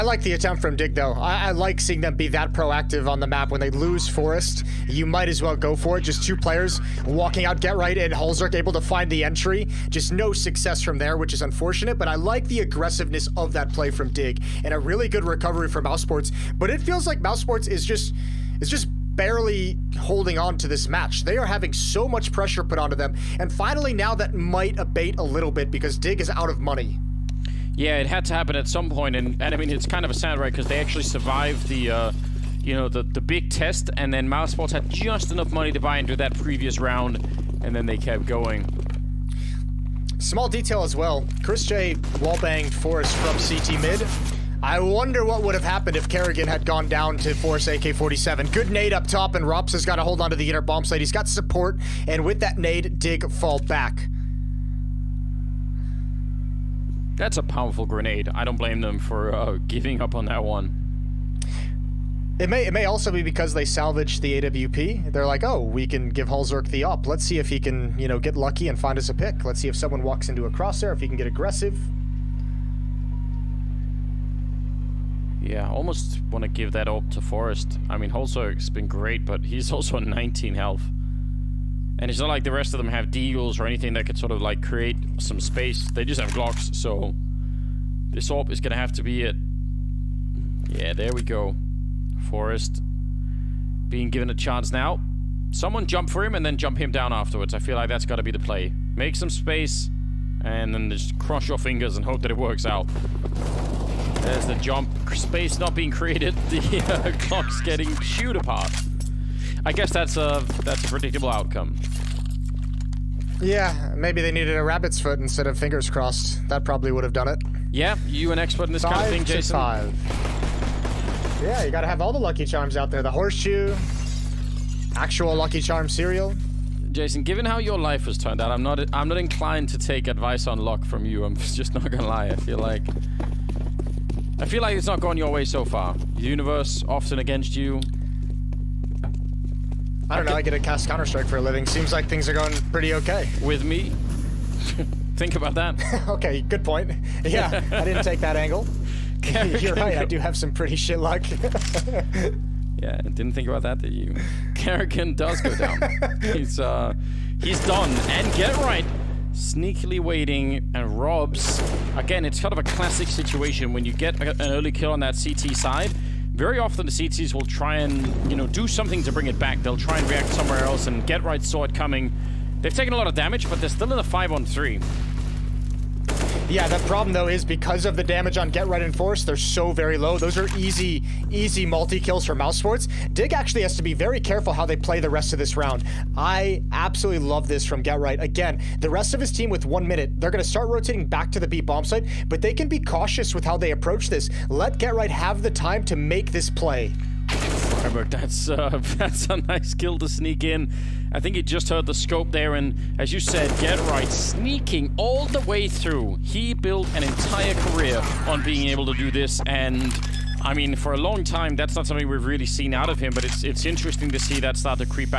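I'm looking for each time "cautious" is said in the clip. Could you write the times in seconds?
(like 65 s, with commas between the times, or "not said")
192 s.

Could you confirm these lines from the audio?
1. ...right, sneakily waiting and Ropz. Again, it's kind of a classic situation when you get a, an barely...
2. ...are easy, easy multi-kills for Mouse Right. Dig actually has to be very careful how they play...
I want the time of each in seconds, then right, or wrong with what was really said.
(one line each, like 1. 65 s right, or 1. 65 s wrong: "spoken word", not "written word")
1. 158 s wrong: "early", not "barely"
2. 180 s wrong: "Sports", not "Right".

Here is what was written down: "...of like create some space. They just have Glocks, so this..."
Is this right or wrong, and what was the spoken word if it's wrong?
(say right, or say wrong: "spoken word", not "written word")
right.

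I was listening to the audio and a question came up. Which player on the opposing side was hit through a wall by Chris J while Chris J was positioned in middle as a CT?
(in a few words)
Forrest.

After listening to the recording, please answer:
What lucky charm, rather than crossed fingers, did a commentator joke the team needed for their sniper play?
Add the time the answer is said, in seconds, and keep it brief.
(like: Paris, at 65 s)
a rabbit's foot, at 114 s.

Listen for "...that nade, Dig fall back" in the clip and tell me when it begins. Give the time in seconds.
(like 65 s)
52 s.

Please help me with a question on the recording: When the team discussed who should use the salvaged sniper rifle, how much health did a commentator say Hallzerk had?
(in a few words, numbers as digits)
19.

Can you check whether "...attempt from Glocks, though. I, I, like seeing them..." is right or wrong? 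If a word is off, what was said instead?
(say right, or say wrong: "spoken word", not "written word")
wrong: "Dig", not "Glocks".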